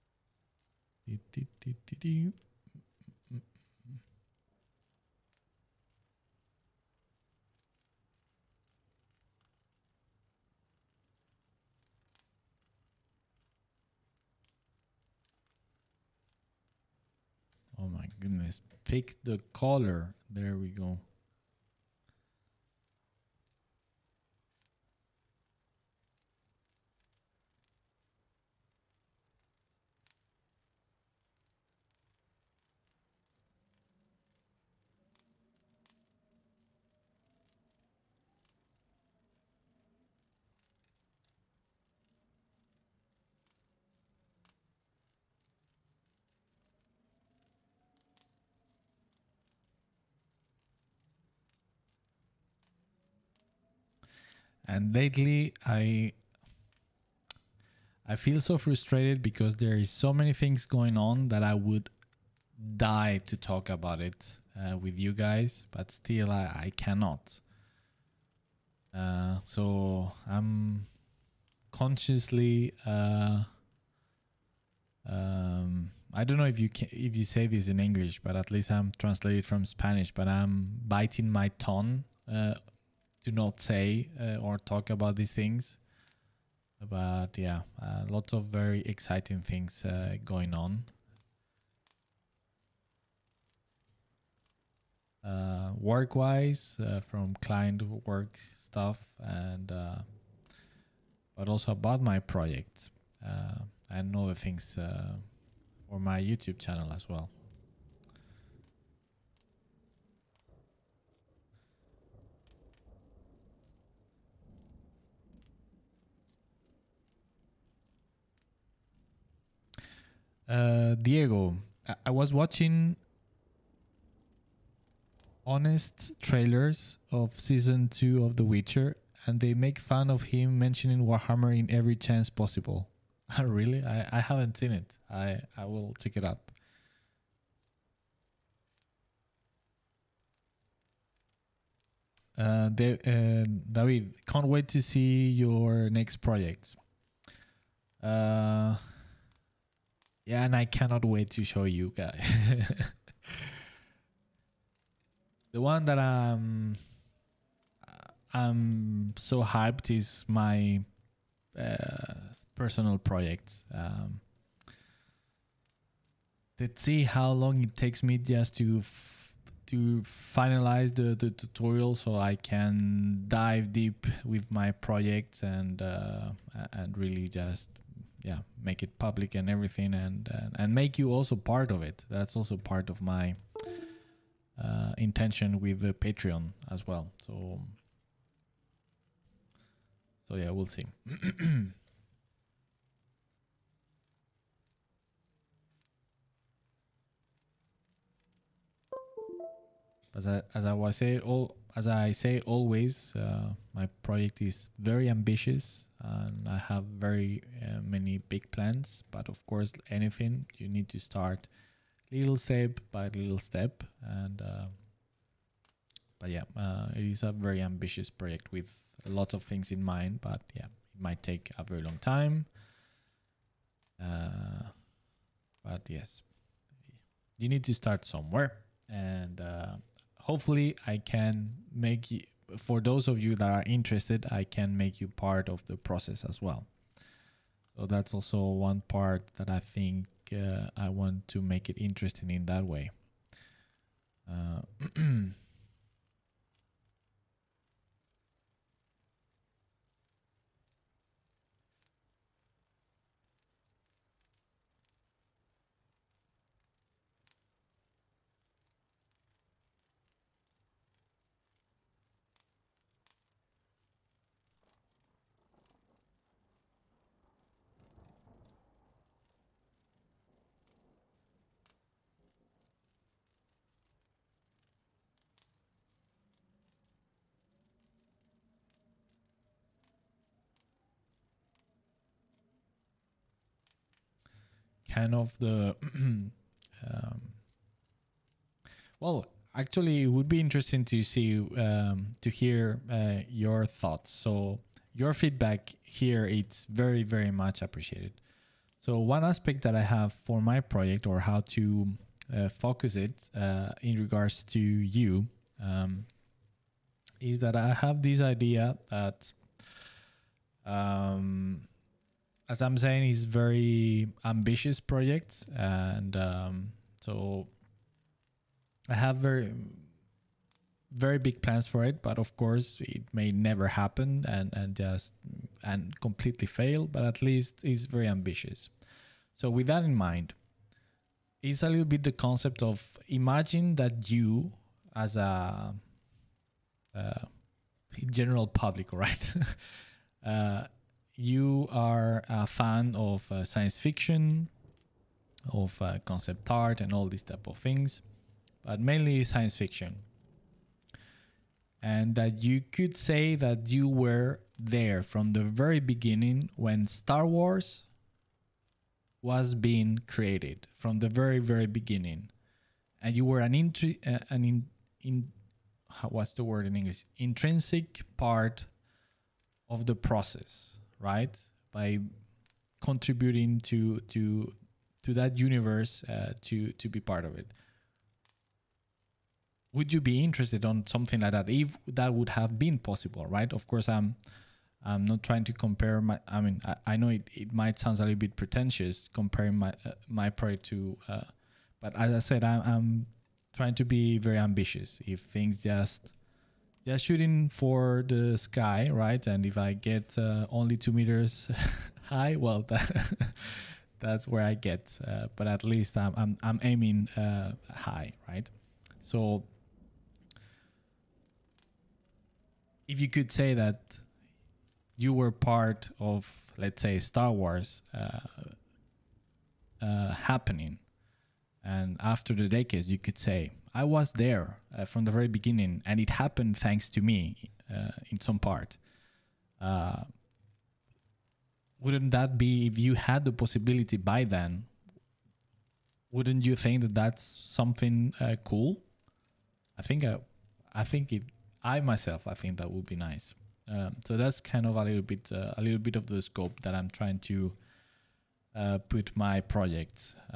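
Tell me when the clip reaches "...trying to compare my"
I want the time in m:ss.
6:25.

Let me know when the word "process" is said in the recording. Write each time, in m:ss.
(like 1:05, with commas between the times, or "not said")
3:55, 6:09.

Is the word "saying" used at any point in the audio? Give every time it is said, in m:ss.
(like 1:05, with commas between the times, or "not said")
3:20, 5:12.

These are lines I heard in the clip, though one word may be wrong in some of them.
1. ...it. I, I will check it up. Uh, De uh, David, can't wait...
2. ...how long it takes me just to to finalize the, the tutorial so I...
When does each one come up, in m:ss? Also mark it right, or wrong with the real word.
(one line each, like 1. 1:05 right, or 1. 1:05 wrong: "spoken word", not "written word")
1. 2:14 right
2. 2:47 right.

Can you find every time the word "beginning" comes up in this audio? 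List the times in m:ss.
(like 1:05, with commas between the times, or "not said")
5:55, 6:01, 7:05.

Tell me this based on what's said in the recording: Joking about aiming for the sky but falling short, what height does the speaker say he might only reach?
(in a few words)
2 meters.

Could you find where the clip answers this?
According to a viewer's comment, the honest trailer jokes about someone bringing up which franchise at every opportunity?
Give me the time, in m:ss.
2:11.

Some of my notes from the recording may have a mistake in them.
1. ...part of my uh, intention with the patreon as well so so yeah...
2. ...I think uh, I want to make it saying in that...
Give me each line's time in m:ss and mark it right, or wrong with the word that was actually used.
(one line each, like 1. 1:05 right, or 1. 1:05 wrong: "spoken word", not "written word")
1. 3:02 right
2. 3:59 wrong: "interesting", not "saying".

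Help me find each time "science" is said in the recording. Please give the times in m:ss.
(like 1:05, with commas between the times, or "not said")
5:43, 5:49.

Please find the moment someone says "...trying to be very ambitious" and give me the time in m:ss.
6:33.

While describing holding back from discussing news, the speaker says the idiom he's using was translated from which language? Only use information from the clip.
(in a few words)
Spanish.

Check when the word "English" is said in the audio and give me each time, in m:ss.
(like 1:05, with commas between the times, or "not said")
1:17, 6:06.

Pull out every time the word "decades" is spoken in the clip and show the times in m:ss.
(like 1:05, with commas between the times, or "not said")
7:02.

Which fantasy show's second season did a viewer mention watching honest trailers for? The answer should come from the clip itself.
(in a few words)
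The Witcher.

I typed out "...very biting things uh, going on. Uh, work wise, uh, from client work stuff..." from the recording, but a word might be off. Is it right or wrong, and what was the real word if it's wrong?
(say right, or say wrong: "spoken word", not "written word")
wrong: "exciting", not "biting".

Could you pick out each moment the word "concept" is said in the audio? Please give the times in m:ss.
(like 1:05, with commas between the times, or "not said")
5:32, 5:46.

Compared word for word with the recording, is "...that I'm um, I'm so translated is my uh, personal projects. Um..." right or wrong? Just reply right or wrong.
wrong.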